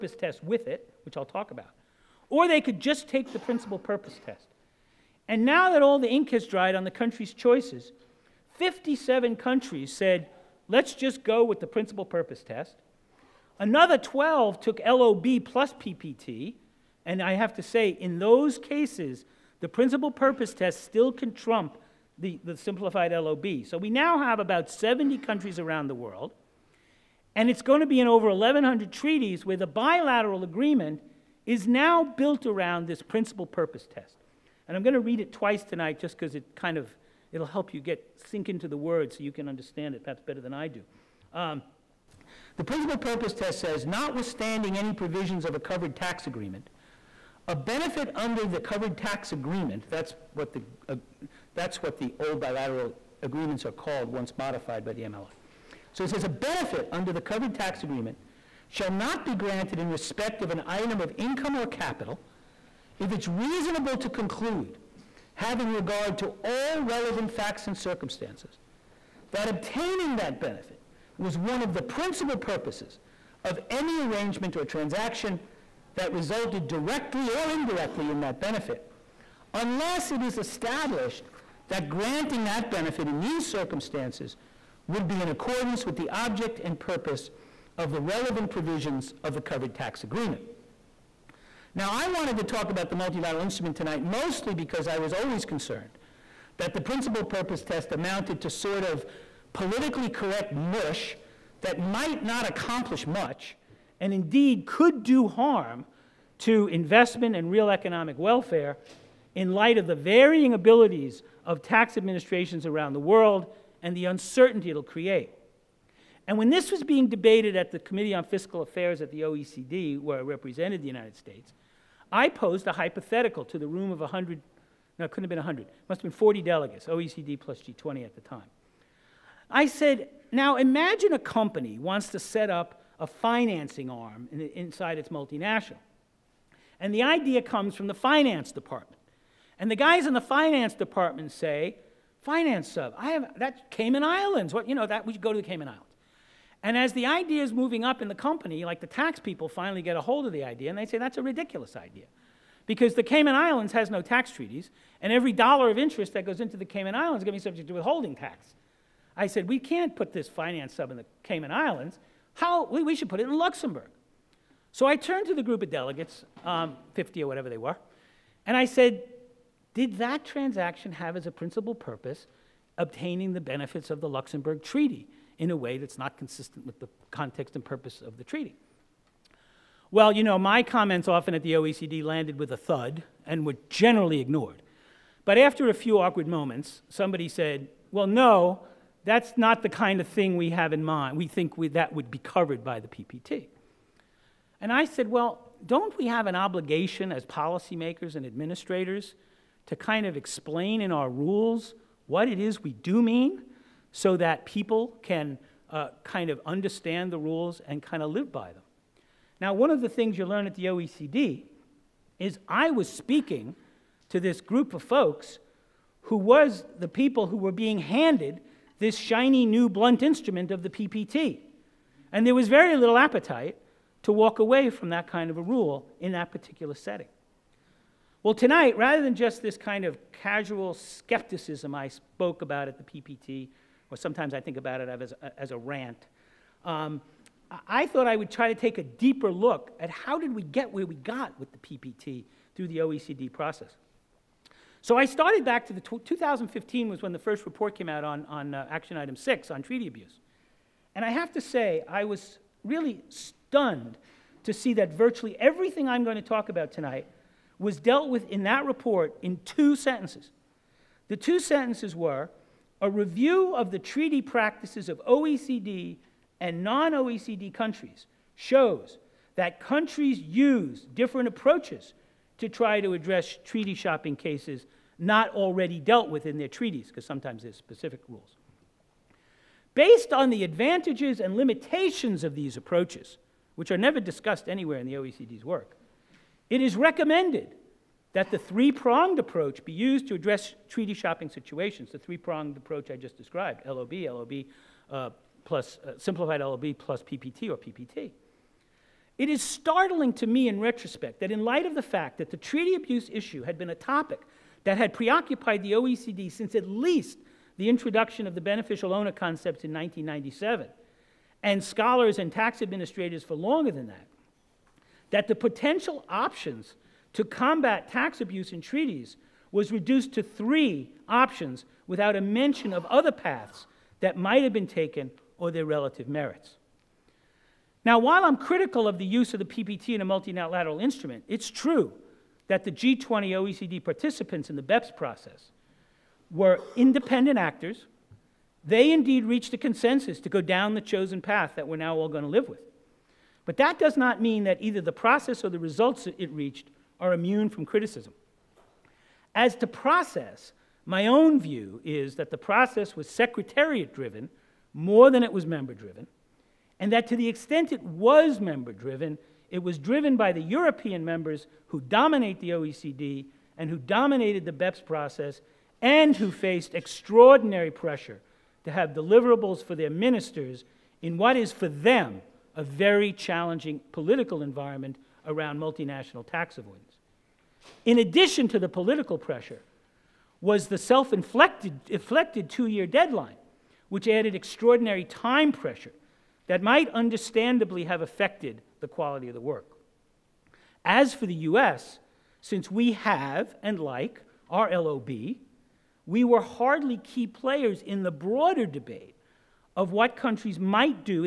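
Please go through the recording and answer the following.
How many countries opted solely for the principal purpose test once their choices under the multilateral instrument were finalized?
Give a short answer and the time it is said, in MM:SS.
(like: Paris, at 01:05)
57, at 00:08.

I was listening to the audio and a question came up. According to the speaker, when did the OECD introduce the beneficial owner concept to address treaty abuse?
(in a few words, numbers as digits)
1997.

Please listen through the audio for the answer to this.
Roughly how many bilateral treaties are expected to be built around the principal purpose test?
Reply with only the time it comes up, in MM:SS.
00:28.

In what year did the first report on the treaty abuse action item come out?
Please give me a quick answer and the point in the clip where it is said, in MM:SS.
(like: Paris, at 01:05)
2015, at 04:05.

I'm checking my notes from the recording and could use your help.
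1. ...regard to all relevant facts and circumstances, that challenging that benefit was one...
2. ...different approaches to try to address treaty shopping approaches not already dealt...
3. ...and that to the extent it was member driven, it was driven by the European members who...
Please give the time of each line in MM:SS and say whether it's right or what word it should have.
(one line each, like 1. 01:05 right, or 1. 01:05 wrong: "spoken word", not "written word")
1. 01:05 wrong: "obtaining", not "challenging"
2. 04:30 wrong: "cases", not "approaches"
3. 05:56 right.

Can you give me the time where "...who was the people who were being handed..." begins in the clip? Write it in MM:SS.
03:36.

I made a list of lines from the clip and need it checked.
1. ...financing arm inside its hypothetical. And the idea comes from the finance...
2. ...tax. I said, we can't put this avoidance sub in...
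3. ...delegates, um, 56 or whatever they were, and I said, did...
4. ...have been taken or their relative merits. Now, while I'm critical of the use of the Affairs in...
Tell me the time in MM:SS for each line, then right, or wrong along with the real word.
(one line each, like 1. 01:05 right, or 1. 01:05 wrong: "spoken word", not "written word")
1. 02:13 wrong: "multinational", not "hypothetical"
2. 02:38 wrong: "finance", not "avoidance"
3. 02:45 wrong: "50", not "56"
4. 05:24 wrong: "PPT", not "Affairs".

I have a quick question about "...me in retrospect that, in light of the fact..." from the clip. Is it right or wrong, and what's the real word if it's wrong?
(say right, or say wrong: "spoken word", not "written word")
right.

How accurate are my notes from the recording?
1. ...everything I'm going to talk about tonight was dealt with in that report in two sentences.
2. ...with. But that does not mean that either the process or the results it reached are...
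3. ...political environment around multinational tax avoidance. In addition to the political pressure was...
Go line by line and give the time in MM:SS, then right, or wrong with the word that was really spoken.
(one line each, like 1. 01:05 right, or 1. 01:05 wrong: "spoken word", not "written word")
1. 04:15 right
2. 05:42 right
3. 06:13 right.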